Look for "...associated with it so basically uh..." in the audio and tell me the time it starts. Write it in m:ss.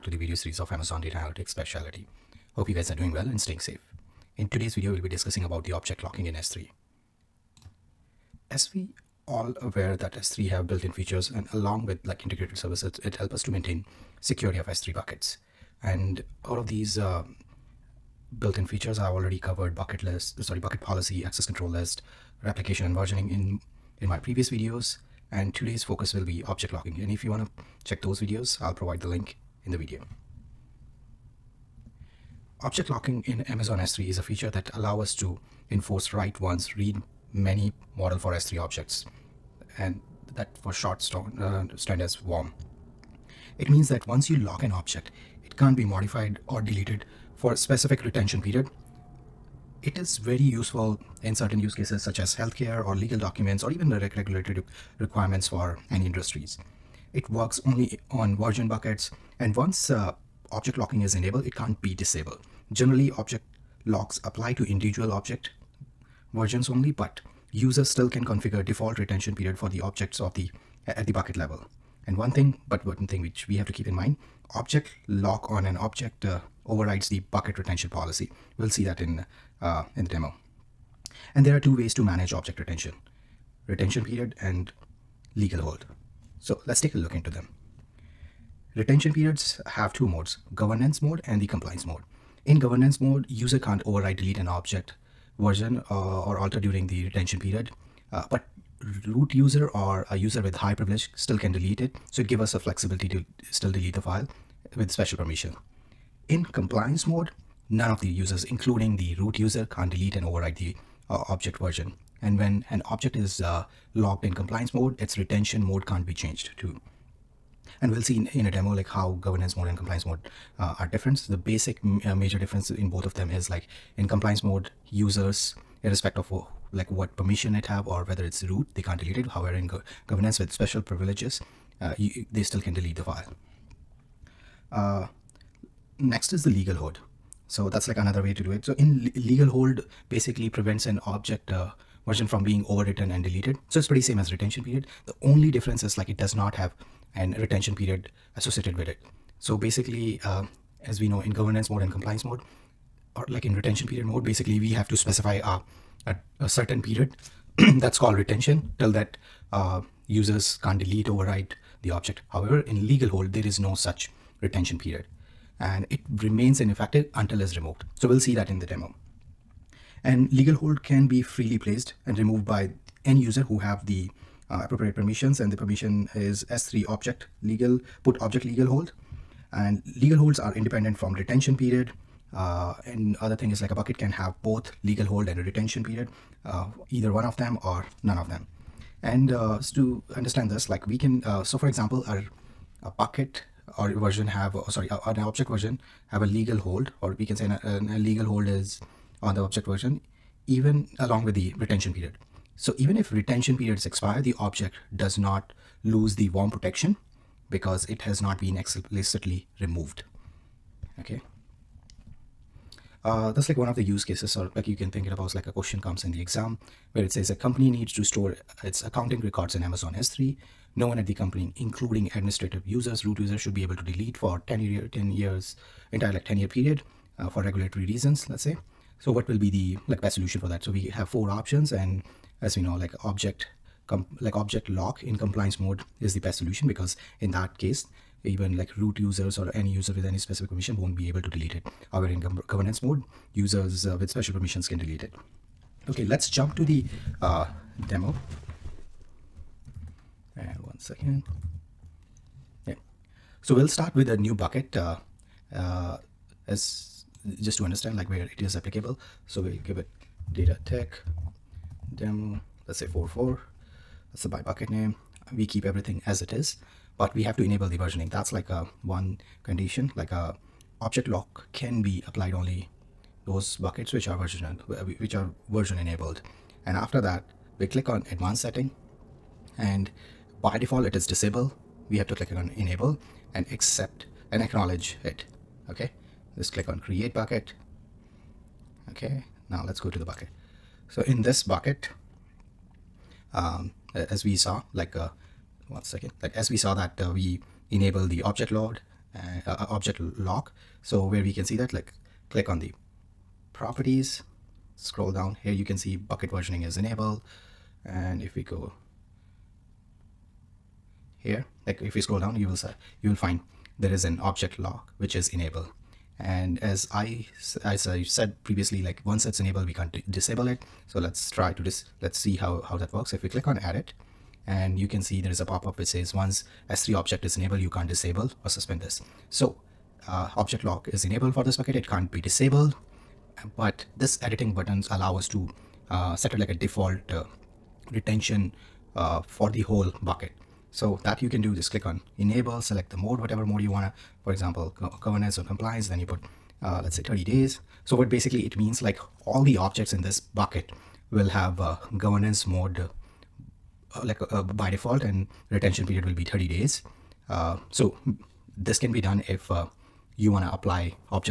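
2:28.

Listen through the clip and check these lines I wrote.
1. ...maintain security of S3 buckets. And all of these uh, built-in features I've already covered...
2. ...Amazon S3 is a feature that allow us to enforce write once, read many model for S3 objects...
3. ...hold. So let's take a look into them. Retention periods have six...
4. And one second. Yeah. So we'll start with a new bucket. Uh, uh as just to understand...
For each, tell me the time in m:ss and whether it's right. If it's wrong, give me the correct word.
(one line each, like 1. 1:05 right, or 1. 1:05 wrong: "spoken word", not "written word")
1. 0:13 right
2. 0:33 right
3. 1:25 wrong: "two", not "six"
4. 4:10 right.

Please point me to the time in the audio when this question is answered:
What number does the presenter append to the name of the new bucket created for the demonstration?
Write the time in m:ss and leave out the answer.
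4:22.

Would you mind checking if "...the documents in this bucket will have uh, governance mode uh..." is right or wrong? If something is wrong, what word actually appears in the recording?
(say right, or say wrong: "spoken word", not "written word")
wrong: "objects", not "documents".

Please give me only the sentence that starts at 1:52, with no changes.
And when an object is uh, in compliance mode, its retention mode can't be changed too.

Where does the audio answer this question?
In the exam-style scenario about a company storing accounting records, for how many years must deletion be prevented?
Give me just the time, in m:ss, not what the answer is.
3:44.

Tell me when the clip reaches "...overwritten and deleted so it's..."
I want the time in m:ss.
2:22.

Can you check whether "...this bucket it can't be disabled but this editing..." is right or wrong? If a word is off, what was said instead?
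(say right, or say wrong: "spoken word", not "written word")
right.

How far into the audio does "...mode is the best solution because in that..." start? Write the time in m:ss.
3:55.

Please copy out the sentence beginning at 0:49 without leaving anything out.
It is very useful in certain use cases such as healthcare or legal documents or even the regulatory requirements for any industries.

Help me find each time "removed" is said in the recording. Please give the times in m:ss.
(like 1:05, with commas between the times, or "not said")
2:47, 2:52, 3:29.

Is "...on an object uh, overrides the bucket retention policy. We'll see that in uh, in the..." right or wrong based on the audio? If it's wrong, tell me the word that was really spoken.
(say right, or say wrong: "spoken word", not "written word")
right.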